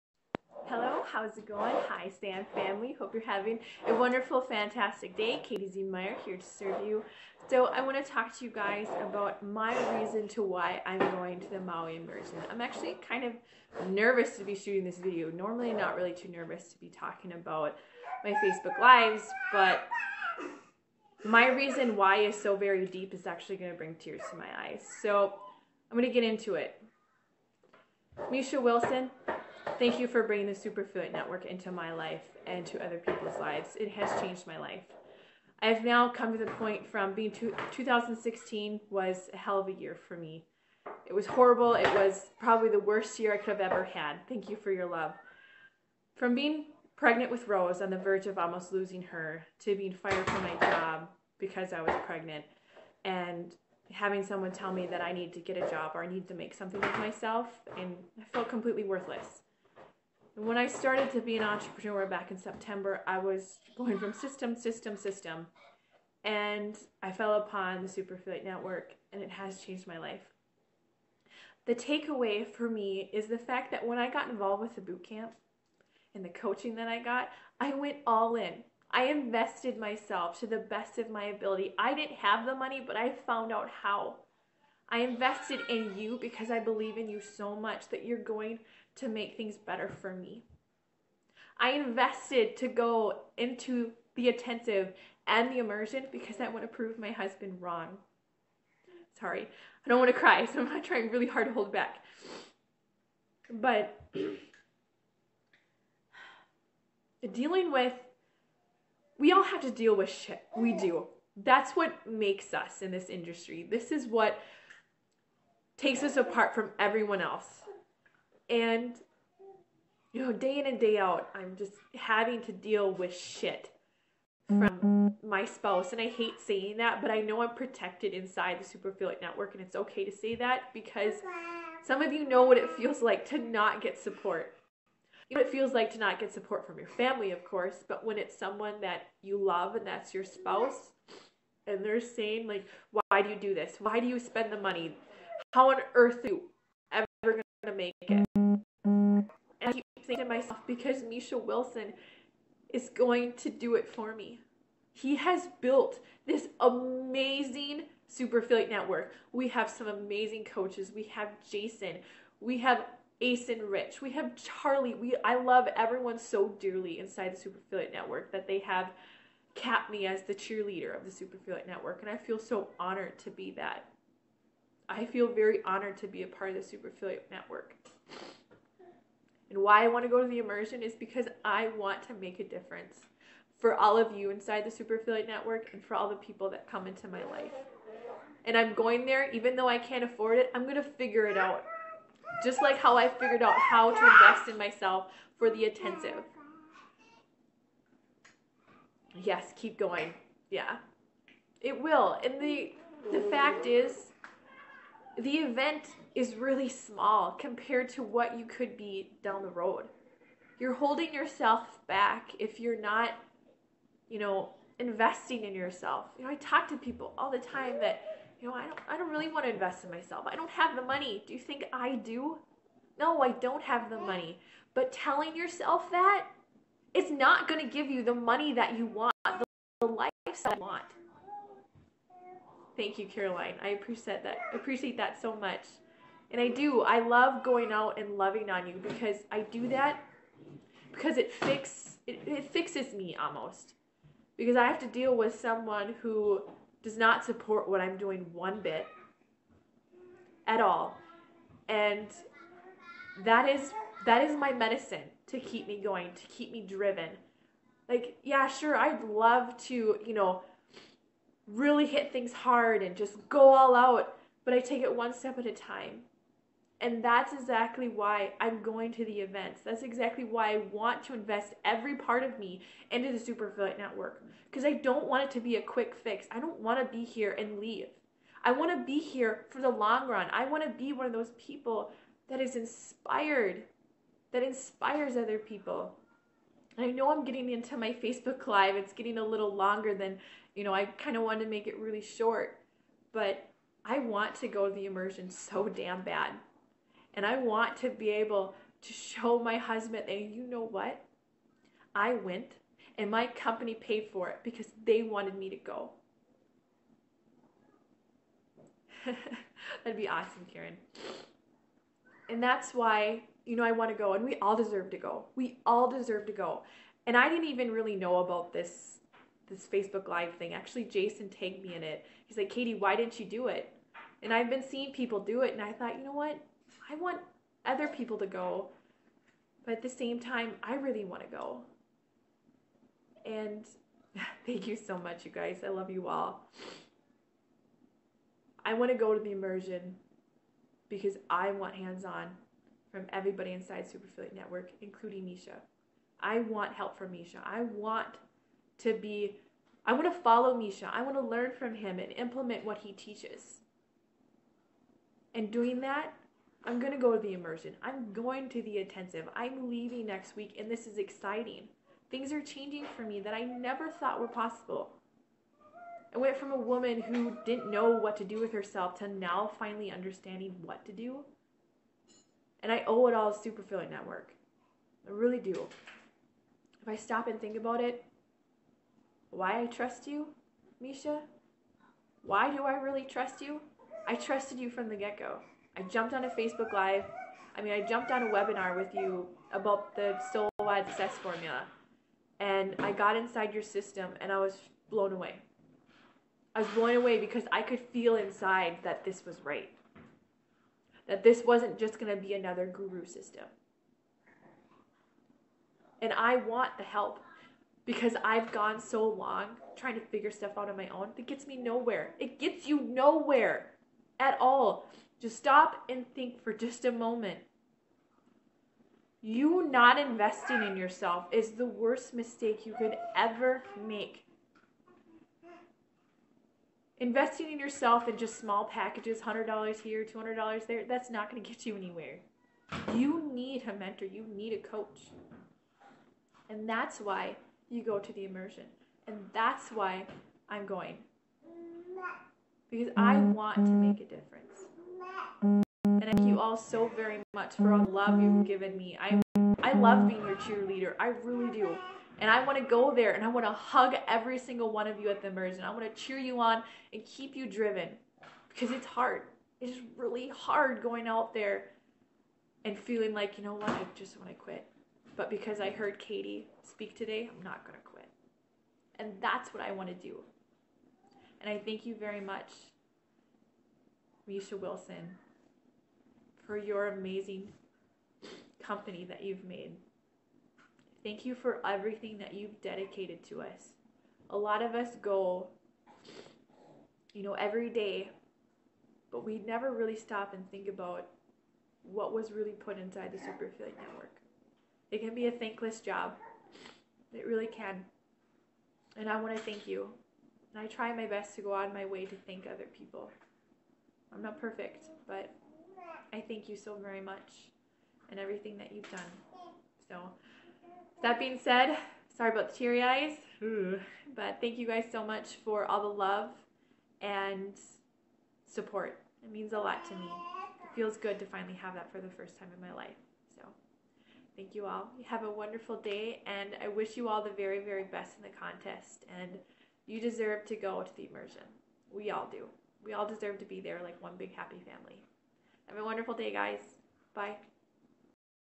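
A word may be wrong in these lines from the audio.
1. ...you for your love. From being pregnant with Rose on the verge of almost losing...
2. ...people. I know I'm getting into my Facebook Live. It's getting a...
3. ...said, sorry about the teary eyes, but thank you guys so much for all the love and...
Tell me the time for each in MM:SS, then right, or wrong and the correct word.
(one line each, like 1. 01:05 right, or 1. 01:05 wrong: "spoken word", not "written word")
1. 00:44 right
2. 04:45 right
3. 08:31 right.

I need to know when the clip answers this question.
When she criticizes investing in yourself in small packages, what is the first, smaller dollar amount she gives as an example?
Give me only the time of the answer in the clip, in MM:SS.
07:09.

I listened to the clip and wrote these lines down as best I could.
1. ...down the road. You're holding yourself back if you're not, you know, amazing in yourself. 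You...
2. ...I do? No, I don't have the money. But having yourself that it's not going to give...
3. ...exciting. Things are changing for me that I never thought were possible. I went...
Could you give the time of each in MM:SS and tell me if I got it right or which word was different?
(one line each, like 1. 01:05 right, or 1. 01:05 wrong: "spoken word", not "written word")
1. 03:29 wrong: "investing", not "amazing"
2. 03:41 wrong: "telling", not "having"
3. 06:00 right.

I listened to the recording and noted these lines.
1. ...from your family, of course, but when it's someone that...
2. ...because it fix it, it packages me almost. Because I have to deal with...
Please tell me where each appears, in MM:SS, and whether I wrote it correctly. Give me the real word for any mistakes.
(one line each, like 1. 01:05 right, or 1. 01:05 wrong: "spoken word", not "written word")
1. 02:16 right
2. 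04:00 wrong: "fixes", not "packages".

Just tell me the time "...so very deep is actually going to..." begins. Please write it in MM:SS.
00:22.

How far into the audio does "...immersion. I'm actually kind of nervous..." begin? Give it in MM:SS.
00:11.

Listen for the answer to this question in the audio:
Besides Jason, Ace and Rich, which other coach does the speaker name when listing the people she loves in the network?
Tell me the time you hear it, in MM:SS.
02:44.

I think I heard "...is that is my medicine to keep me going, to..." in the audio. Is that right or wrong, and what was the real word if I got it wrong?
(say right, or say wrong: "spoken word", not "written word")
right.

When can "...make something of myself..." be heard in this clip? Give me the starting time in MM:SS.
00:56.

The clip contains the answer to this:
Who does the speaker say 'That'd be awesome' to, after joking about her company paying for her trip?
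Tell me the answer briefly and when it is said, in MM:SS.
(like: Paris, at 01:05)
Karen, at 05:10.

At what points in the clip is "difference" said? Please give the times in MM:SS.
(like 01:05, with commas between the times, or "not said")
03:02, 07:24.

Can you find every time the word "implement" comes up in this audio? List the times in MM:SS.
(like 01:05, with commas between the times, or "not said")
05:52.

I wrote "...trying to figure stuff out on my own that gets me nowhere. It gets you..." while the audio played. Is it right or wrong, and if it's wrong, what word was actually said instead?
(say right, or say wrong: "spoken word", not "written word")
right.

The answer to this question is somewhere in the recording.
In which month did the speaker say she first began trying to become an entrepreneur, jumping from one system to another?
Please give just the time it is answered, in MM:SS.
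01:02.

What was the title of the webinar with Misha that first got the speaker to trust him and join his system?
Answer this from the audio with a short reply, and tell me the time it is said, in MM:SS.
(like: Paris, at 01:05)
Soul Wide Success Formula, at 06:30.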